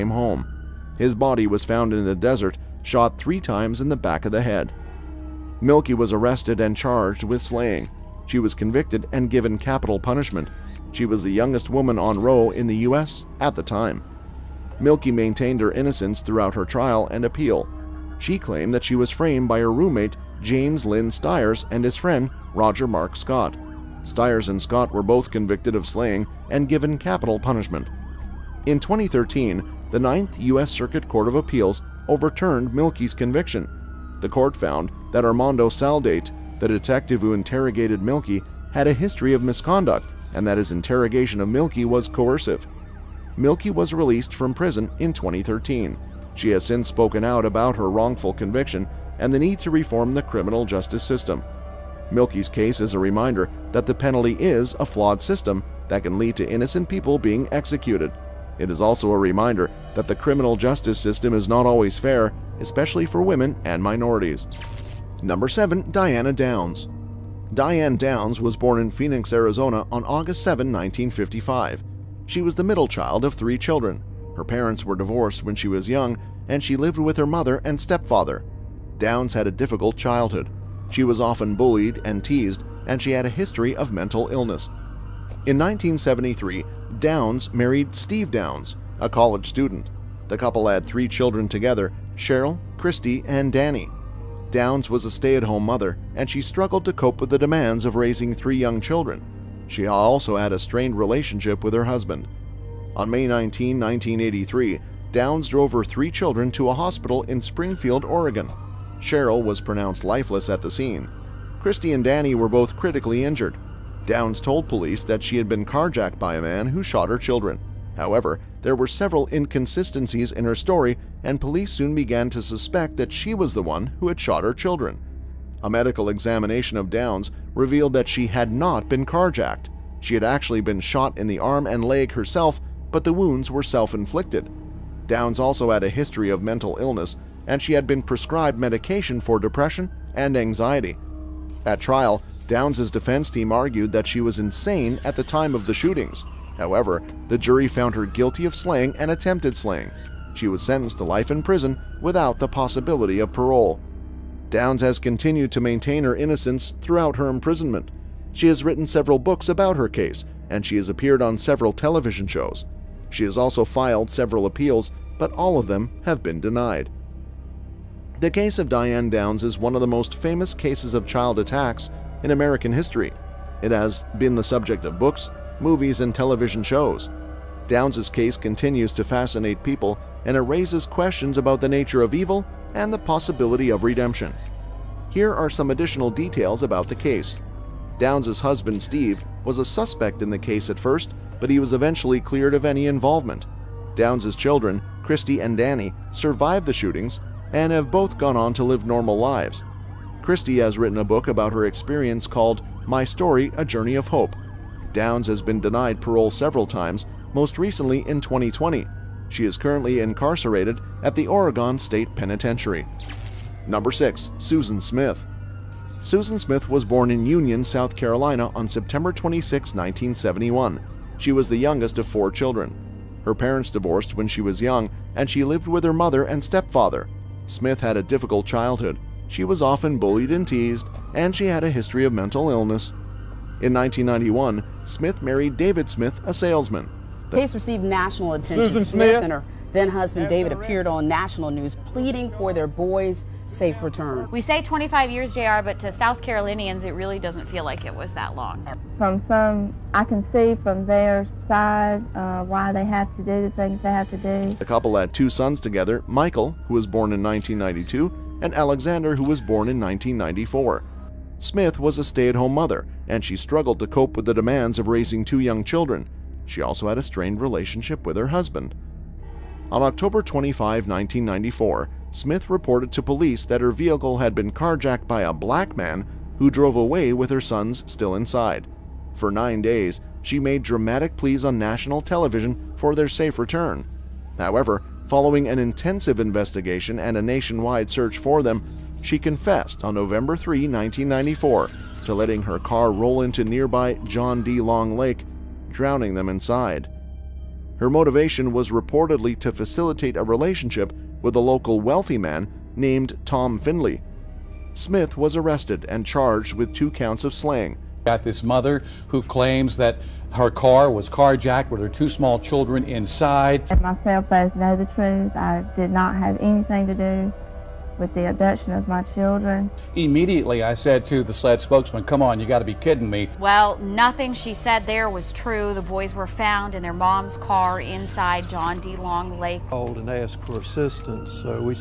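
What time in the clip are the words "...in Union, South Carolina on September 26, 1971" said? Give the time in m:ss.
3:37.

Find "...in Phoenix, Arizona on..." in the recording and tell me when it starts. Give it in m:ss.
1:08.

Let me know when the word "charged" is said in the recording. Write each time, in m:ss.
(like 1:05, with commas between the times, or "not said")
0:06, 5:06.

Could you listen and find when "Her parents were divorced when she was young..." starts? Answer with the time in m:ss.
1:14.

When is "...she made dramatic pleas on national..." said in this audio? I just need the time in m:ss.
4:40.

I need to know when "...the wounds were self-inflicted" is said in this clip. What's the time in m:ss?
2:13.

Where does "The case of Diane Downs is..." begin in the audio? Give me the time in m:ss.
2:48.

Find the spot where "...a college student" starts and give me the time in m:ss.
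1:28.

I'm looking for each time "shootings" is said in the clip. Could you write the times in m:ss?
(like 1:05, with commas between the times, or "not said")
2:25, 3:16.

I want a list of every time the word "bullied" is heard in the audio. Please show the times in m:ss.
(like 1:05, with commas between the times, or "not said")
1:21, 3:49.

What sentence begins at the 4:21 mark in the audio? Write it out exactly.
Smith was a stay at home mother, and she struggled to cope with the demands of raising two young children.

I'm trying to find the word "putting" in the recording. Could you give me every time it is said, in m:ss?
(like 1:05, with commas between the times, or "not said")
not said.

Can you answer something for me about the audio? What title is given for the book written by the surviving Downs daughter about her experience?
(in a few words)
My Story A Journey of Hope.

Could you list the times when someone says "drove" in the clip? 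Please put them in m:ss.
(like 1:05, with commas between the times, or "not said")
1:45, 4:36.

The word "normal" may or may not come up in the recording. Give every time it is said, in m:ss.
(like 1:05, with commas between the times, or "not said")
3:18.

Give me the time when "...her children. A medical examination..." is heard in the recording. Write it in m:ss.
2:04.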